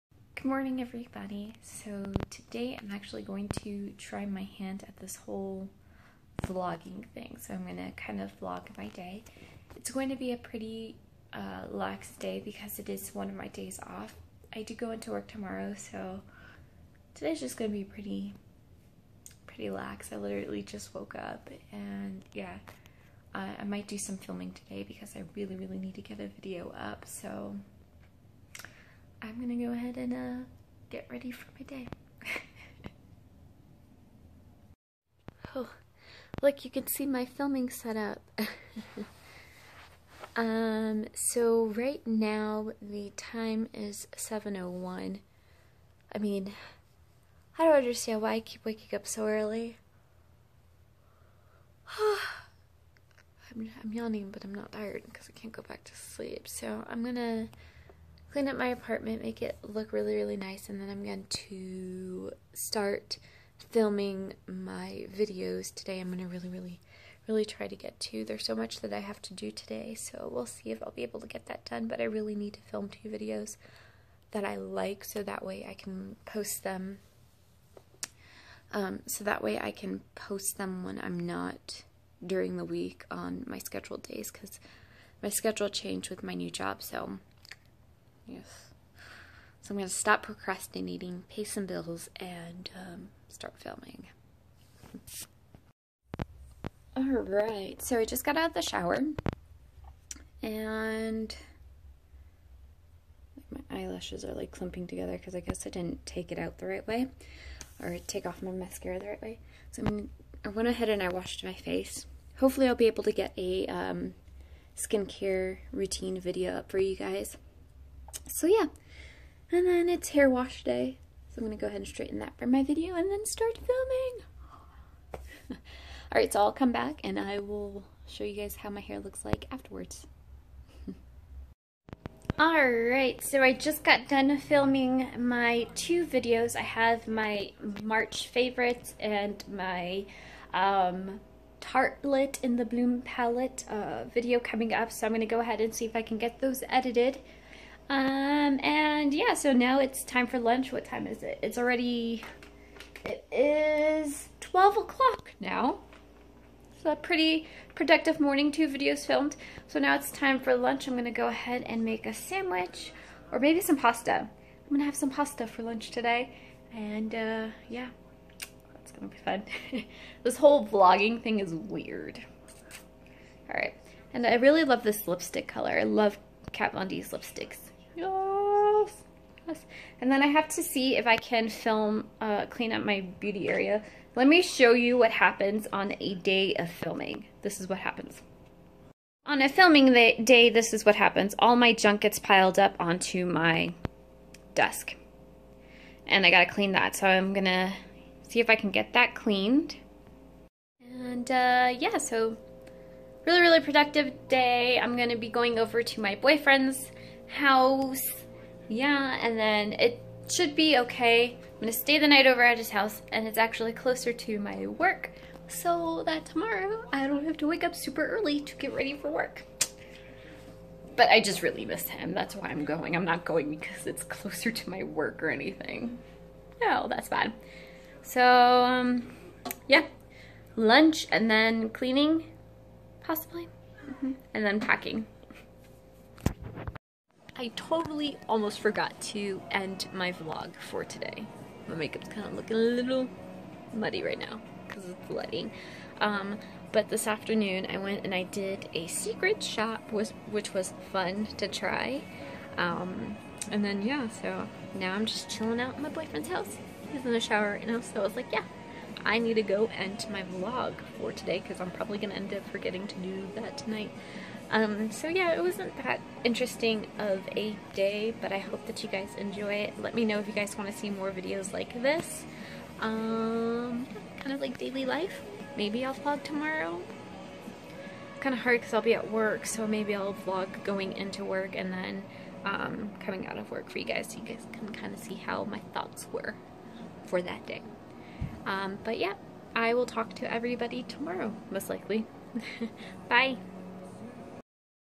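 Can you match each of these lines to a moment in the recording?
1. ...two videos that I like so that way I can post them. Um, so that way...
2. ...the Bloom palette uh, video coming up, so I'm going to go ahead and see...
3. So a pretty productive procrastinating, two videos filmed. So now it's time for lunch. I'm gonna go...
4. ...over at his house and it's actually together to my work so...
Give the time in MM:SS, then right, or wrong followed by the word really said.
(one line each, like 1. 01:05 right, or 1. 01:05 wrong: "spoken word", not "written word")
1. 01:12 right
2. 02:22 right
3. 02:36 wrong: "morning", not "procrastinating"
4. 03:32 wrong: "closer", not "together".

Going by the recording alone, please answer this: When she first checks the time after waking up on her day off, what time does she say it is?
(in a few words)
7:01.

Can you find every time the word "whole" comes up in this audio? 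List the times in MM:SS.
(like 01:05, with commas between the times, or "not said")
00:05, 02:50.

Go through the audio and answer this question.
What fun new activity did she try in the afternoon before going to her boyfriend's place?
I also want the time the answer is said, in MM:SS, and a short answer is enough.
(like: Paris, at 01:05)
a secret shop, at 04:08.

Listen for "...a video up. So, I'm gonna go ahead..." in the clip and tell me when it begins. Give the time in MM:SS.
00:26.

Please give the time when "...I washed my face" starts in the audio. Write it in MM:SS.
01:51.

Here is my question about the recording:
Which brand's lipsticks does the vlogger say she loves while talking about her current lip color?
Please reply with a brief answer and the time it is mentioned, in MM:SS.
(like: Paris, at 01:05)
Kat Von D, at 02:56.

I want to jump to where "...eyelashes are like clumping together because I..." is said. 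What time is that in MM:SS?
01:43.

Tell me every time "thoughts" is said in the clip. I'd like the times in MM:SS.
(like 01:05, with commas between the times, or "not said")
04:45.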